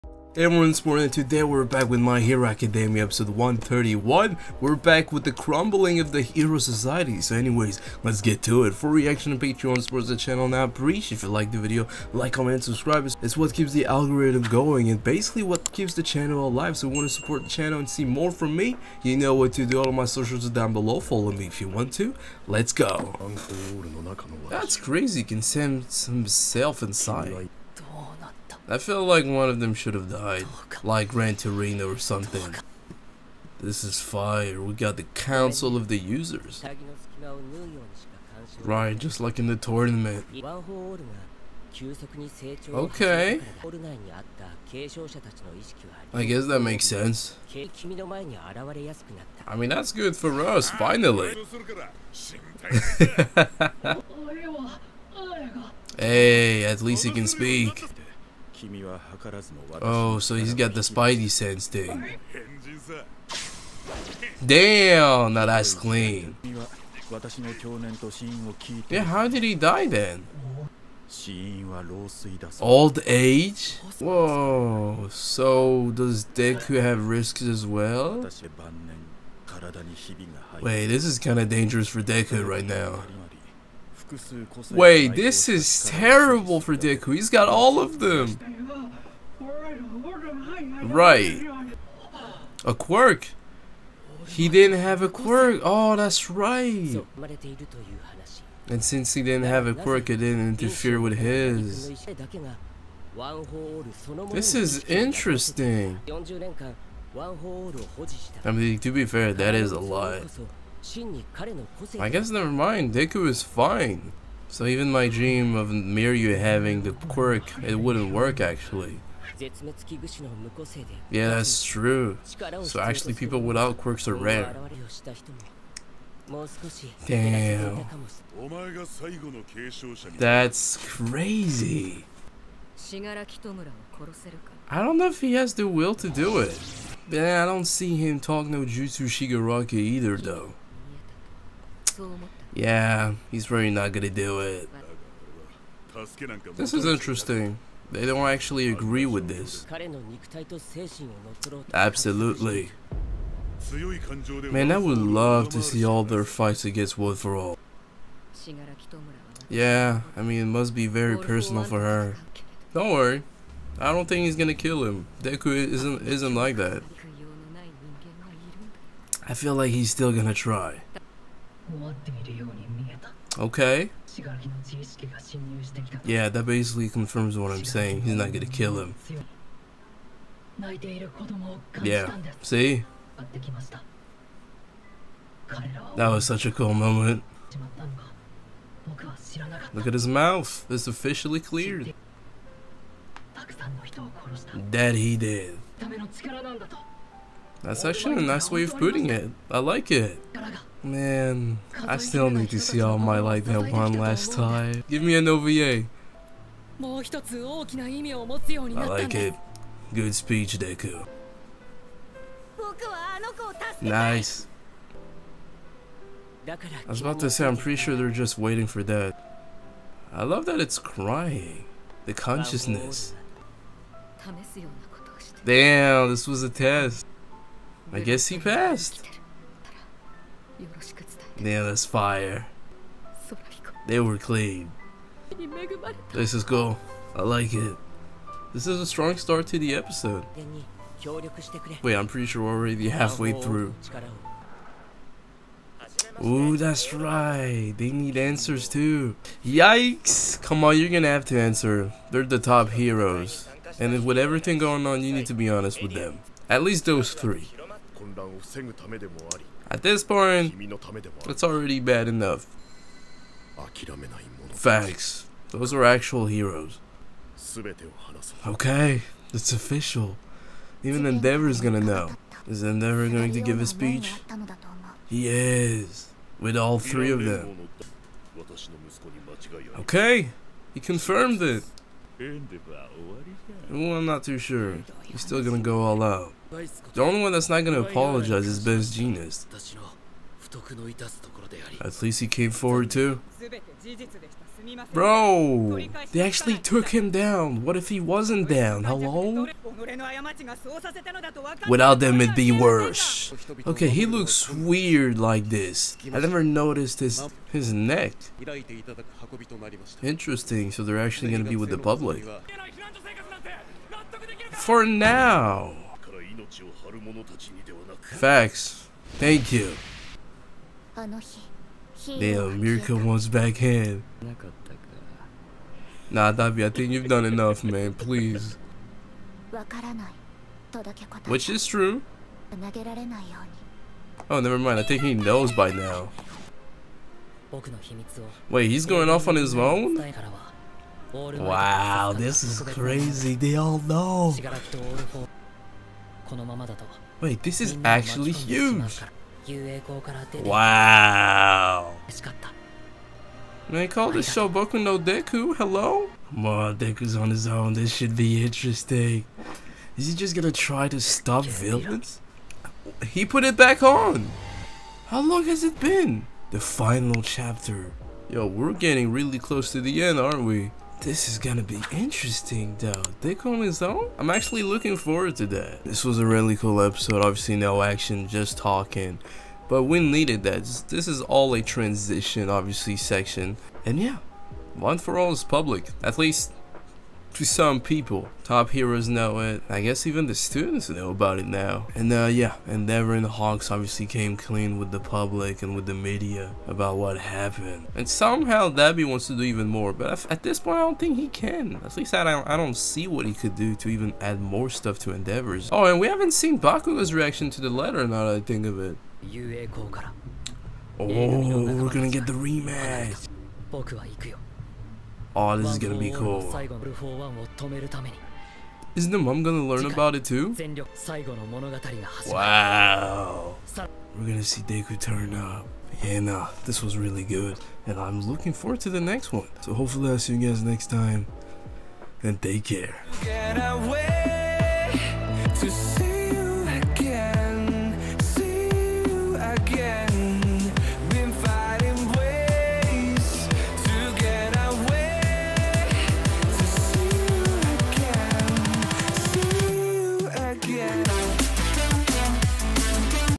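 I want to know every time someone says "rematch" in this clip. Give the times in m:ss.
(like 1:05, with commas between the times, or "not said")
6:52.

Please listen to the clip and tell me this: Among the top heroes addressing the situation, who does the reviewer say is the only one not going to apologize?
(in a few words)
Best Jeanist.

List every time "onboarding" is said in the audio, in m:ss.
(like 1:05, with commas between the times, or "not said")
not said.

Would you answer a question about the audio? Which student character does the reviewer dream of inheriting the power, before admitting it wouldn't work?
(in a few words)
Mirio.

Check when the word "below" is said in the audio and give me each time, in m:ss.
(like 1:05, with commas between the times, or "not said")
0:20.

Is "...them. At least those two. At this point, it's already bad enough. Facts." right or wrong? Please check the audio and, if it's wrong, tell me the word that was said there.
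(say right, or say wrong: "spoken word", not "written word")
wrong: "three", not "two".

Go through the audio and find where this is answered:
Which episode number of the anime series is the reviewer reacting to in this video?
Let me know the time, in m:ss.
0:03.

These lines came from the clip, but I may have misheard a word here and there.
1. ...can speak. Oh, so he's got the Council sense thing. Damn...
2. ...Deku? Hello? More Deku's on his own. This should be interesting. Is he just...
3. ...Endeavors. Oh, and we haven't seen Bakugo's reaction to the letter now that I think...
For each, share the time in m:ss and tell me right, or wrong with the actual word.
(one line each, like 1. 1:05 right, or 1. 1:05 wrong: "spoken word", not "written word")
1. 0:57 wrong: "Spidey", not "Council"
2. 5:54 right
3. 6:45 right.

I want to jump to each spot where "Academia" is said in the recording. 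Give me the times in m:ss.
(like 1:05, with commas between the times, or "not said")
0:02.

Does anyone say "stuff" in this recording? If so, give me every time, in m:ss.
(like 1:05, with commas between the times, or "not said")
6:44.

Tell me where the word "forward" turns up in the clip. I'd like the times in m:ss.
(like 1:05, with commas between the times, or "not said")
4:52, 6:14, 7:08.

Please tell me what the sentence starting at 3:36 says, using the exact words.
I was about to say, I'm pretty sure they're just waiting for that.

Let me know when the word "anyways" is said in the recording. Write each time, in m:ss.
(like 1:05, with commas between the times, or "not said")
0:07.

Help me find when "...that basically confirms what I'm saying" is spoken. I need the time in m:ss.
2:56.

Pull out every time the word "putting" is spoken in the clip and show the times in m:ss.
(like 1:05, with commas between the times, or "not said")
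3:18.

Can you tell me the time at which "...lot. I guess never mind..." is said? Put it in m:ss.
1:49.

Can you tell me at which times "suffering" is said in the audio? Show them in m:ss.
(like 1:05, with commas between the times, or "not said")
not said.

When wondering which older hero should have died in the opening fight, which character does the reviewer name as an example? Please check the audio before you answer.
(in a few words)
Gran Torino.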